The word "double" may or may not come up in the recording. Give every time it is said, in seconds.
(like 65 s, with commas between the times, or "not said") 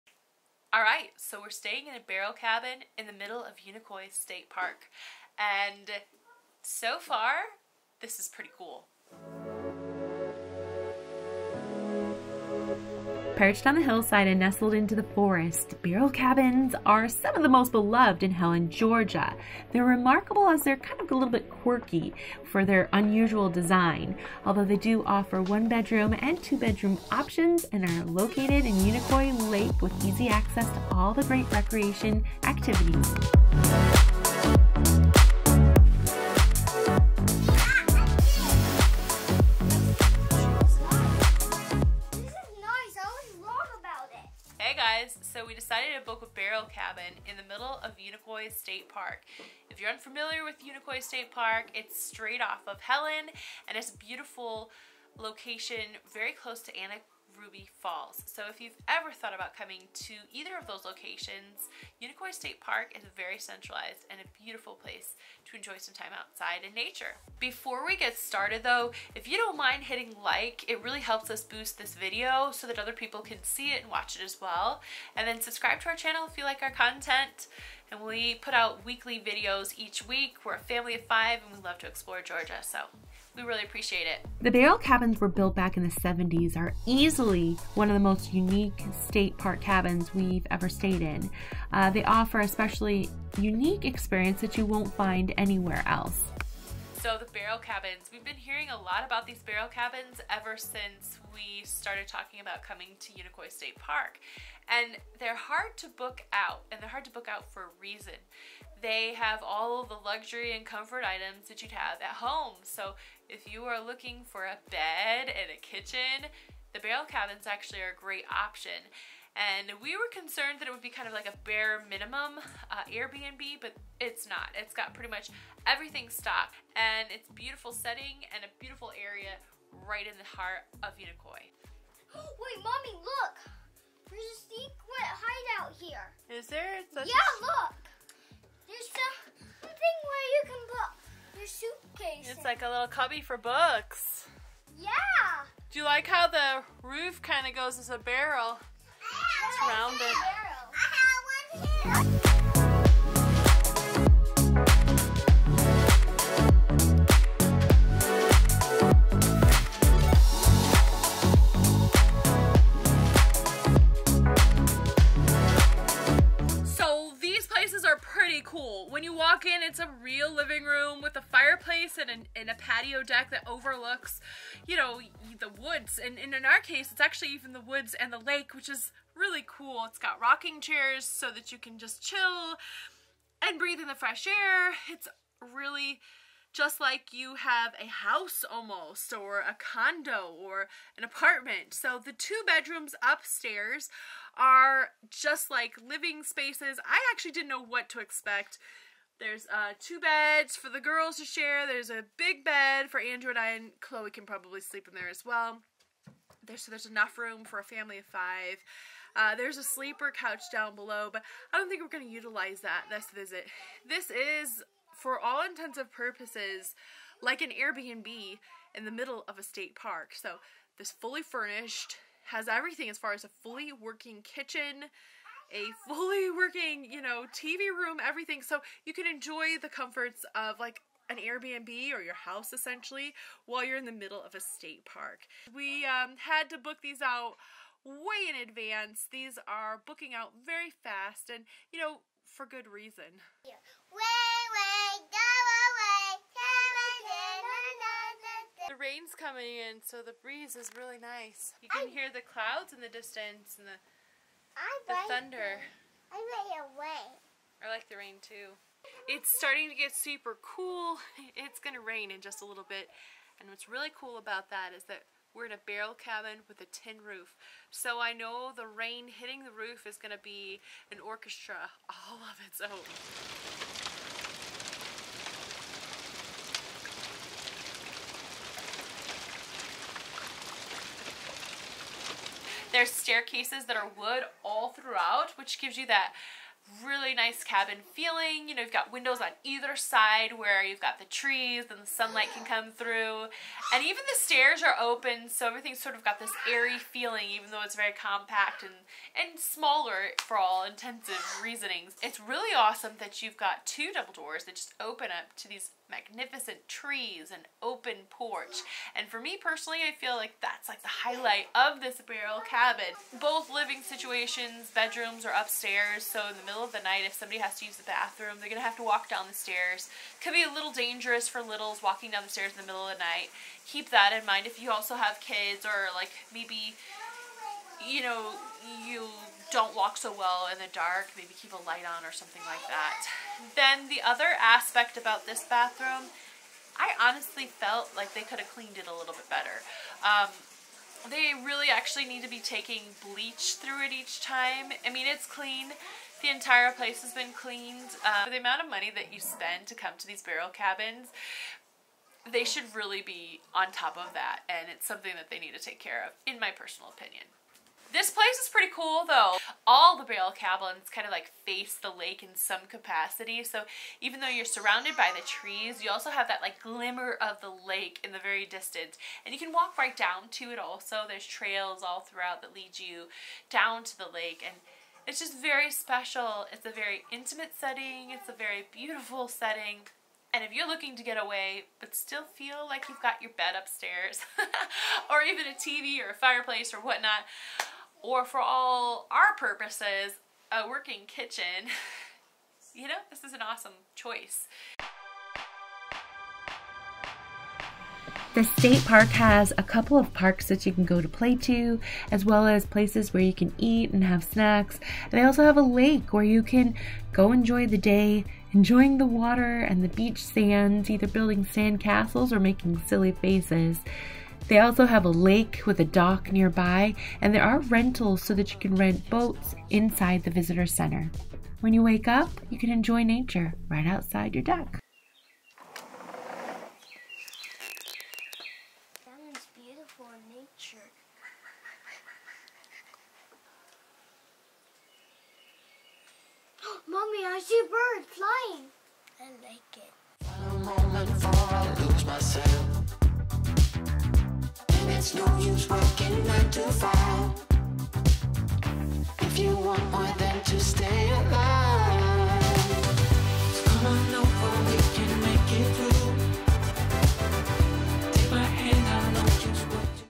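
303 s.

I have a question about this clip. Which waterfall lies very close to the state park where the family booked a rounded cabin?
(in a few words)
Anna Ruby Falls.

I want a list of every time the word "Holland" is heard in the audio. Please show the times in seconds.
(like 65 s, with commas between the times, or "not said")
not said.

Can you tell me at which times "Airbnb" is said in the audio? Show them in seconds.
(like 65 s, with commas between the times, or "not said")
122 s, 217 s, 231 s.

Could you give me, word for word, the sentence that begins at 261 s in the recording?
It's going to rain in just a little bit.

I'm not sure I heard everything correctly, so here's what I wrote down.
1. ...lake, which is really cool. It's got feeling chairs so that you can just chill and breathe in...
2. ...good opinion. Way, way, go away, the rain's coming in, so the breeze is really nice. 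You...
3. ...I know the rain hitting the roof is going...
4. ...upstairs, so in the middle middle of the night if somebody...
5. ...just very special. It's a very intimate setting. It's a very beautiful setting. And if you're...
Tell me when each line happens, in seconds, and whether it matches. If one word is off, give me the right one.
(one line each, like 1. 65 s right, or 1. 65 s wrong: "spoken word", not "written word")
1. 178 s wrong: "rocking", not "feeling"
2. 242 s wrong: "reason", not "opinion"
3. 268 s right
4. 315 s right
5. 375 s right.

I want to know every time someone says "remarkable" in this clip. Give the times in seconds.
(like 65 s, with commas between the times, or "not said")
19 s.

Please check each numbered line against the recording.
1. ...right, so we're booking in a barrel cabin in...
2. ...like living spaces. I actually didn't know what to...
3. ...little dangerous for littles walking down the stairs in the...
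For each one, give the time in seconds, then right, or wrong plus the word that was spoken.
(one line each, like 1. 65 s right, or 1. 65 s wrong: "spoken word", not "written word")
1. 0 s wrong: "staying", not "booking"
2. 195 s right
3. 320 s right.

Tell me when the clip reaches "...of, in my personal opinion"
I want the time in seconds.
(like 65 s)
356 s.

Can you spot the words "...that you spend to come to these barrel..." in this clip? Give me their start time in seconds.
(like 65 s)
348 s.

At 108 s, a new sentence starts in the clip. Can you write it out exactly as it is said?
They have all the luxury and comfort items that you'd have at home.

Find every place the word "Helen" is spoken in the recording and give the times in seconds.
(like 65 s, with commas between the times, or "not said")
18 s, 52 s.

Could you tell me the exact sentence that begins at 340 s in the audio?
Um, they really actually need to be taking bleach through it each time.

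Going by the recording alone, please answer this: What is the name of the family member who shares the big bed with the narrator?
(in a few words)
Andrew.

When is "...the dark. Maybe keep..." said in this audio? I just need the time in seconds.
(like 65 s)
330 s.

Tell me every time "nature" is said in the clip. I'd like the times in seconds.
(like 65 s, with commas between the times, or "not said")
66 s, 423 s.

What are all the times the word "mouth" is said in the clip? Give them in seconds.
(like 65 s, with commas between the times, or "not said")
not said.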